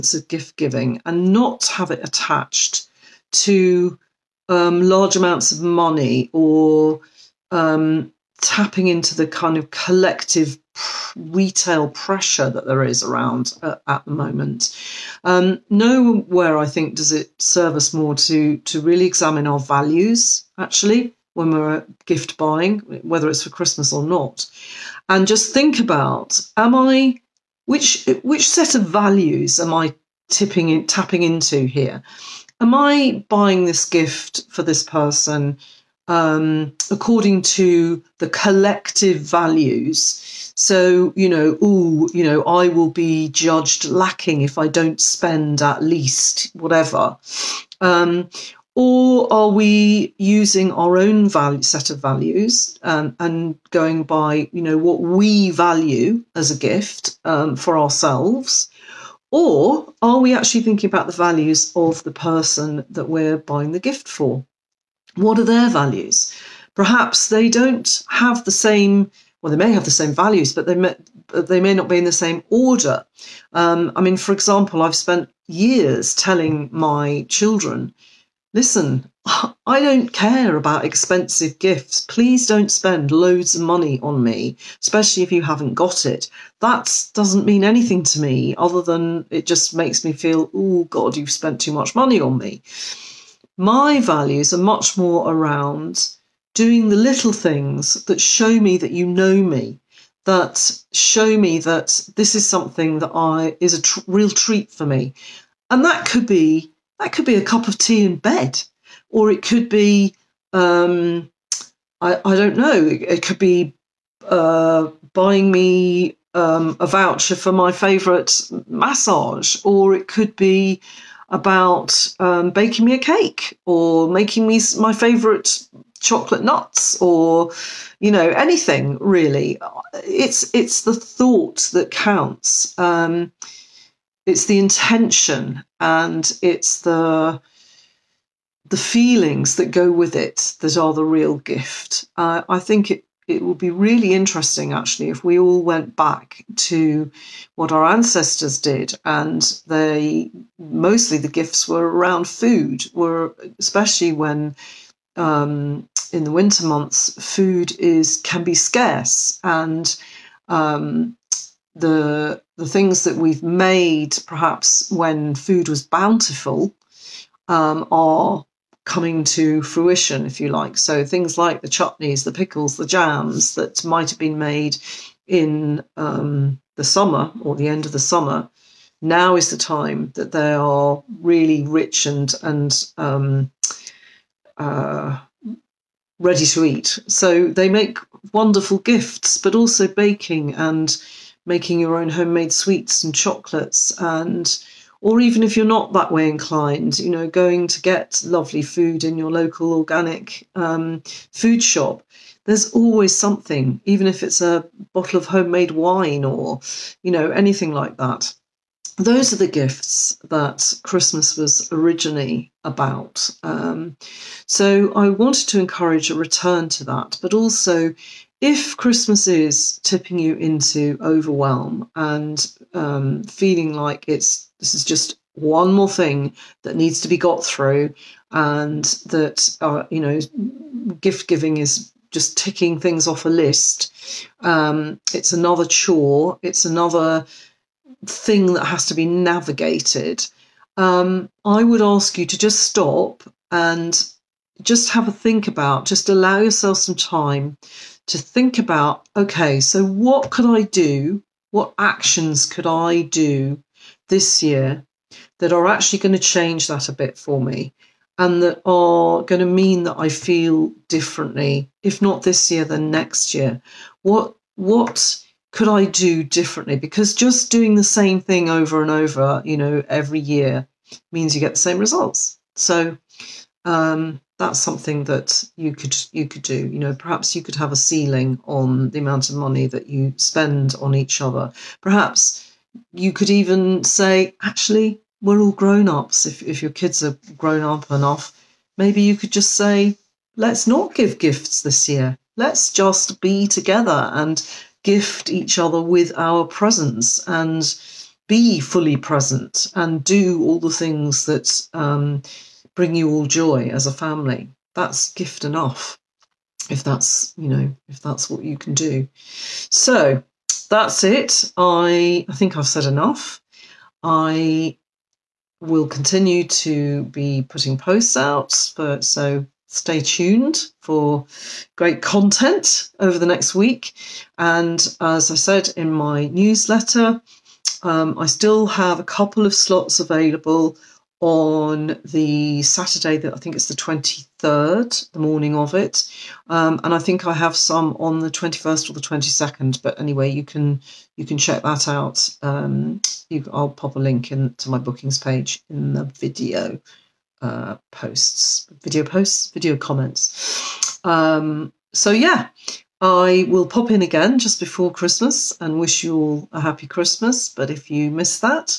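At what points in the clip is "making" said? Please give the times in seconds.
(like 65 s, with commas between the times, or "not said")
124 s, 191 s.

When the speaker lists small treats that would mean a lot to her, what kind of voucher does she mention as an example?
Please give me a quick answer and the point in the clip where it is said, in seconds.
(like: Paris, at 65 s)
Massage, at 118 s.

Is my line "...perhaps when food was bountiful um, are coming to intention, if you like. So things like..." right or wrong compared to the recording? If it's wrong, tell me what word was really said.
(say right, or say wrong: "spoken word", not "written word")
wrong: "fruition", not "intention".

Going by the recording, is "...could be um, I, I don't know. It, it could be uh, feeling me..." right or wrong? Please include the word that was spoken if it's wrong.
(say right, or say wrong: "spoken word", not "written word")
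wrong: "buying", not "feeling".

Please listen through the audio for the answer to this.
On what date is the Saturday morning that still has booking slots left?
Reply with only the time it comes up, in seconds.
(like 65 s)
333 s.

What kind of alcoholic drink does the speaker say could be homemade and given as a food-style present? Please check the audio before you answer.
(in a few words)
Wine.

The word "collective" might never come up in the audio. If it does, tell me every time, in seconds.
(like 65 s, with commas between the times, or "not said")
9 s, 38 s.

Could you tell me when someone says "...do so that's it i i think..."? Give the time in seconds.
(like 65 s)
308 s.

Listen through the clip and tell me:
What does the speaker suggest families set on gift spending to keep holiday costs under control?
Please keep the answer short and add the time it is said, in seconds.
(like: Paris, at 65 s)
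A ceiling, at 277 s.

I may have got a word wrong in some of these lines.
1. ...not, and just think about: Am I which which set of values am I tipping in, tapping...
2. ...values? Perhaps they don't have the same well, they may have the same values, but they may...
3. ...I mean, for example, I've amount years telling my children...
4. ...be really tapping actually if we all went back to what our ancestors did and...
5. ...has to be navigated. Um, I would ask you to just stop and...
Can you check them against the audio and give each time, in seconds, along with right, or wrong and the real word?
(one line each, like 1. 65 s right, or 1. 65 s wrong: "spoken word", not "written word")
1. 24 s right
2. 65 s right
3. 73 s wrong: "spent", not "amount"
4. 143 s wrong: "interesting", not "tapping"
5. 238 s right.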